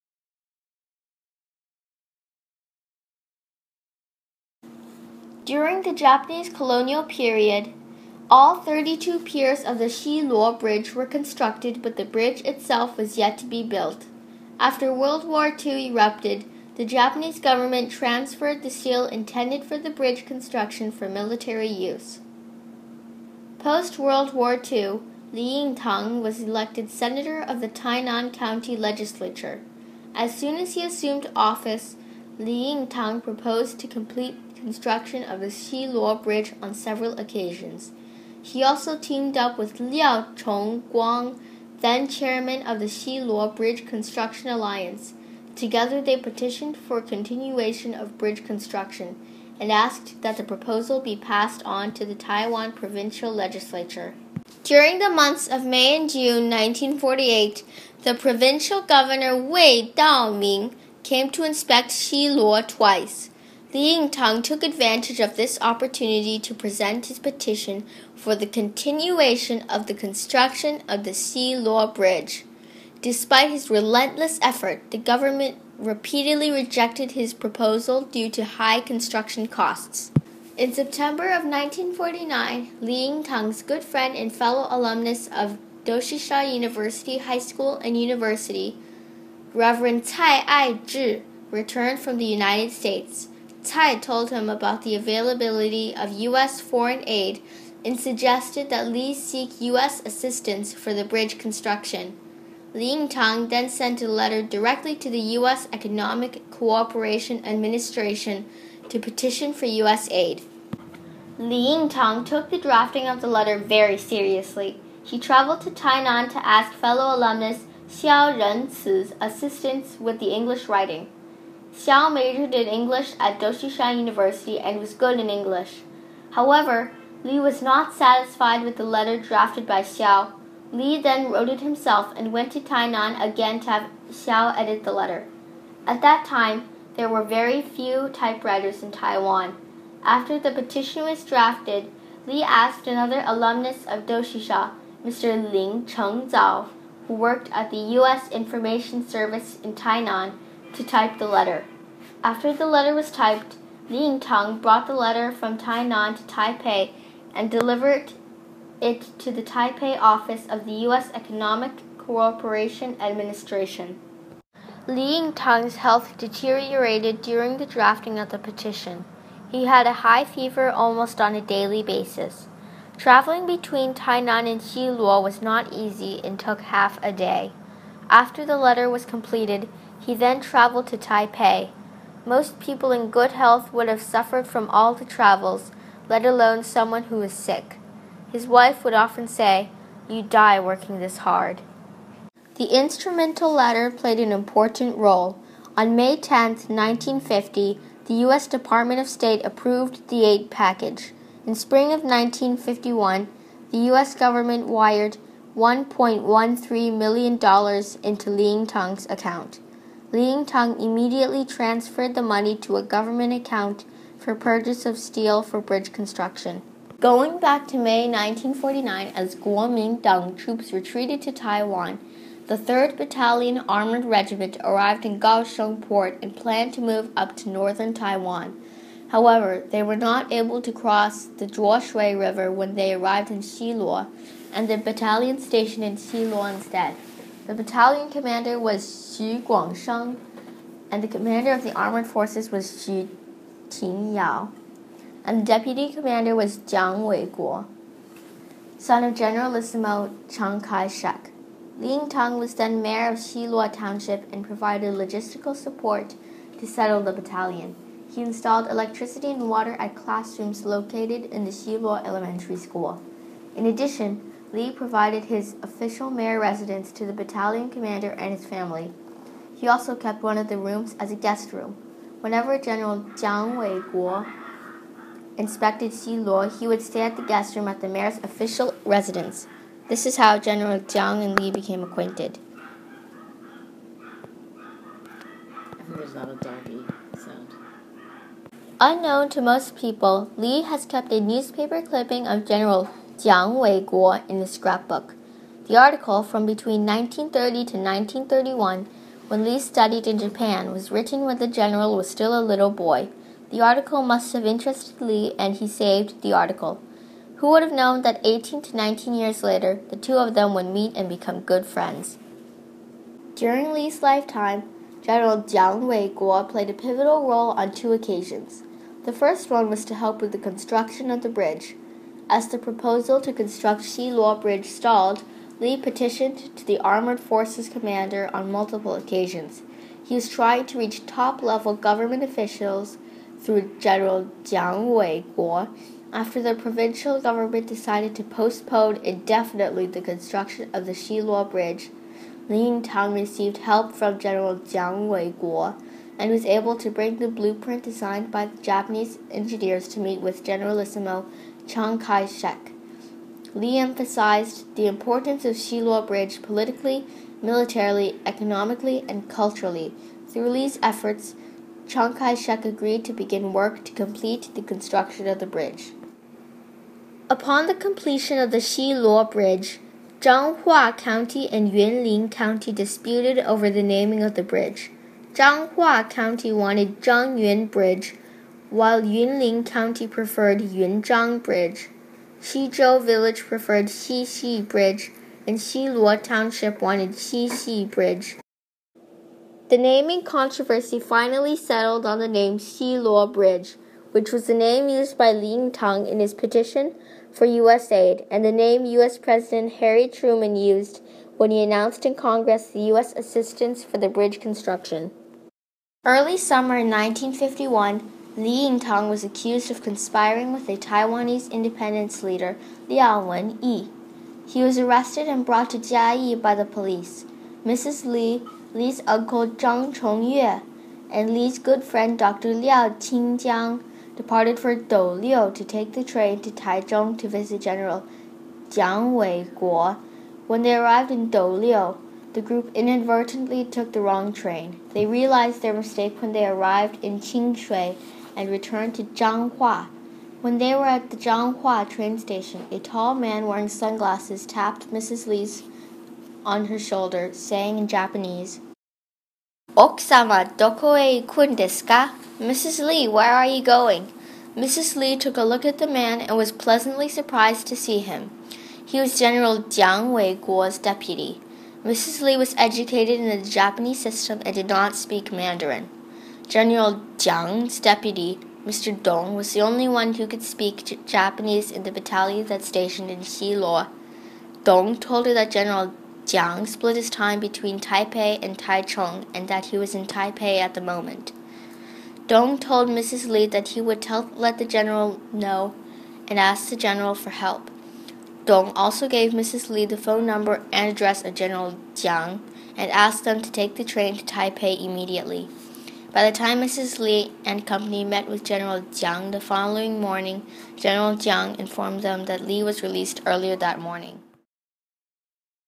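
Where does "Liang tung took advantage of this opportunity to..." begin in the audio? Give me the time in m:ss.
1:03.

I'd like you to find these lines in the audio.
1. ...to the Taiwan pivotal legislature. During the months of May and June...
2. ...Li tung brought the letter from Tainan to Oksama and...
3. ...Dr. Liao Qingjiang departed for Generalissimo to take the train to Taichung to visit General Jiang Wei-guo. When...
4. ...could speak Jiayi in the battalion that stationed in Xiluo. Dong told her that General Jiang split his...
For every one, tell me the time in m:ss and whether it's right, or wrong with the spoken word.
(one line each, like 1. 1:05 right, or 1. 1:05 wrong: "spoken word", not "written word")
1. 0:51 wrong: "provincial", not "pivotal"
2. 2:33 wrong: "Taipei", not "Oksama"
3. 7:02 wrong: "Douliu", not "Generalissimo"
4. 7:50 wrong: "Japanese", not "Jiayi".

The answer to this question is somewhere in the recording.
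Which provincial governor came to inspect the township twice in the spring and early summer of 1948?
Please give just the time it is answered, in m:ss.
0:59.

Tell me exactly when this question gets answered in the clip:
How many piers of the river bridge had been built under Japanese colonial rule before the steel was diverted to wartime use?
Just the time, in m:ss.
0:08.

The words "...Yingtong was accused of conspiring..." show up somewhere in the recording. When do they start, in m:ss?
6:48.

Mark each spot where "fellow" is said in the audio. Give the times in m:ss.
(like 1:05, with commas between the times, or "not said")
1:24, 1:56.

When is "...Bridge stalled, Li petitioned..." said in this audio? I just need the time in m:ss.
5:24.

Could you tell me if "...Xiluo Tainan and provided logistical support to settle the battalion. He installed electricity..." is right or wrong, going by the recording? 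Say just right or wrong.
wrong.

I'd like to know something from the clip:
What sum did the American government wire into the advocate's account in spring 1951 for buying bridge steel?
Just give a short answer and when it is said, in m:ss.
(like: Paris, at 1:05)
$1.13 million, at 3:25.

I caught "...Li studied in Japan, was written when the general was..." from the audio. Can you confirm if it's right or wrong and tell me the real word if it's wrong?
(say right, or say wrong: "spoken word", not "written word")
right.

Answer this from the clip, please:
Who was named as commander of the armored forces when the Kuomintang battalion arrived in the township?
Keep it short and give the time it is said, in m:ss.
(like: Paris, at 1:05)
Xu Tingyao, at 4:02.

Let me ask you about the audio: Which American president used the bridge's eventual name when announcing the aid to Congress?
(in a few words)
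Harry Truman.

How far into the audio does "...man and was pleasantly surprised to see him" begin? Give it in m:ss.
7:35.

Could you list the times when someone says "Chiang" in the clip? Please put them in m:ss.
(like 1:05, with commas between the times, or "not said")
4:10, 5:51, 6:01.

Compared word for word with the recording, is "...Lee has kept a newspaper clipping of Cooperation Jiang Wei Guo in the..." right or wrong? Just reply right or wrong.
wrong.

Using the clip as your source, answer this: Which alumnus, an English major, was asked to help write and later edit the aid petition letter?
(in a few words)
Xiao Renzi.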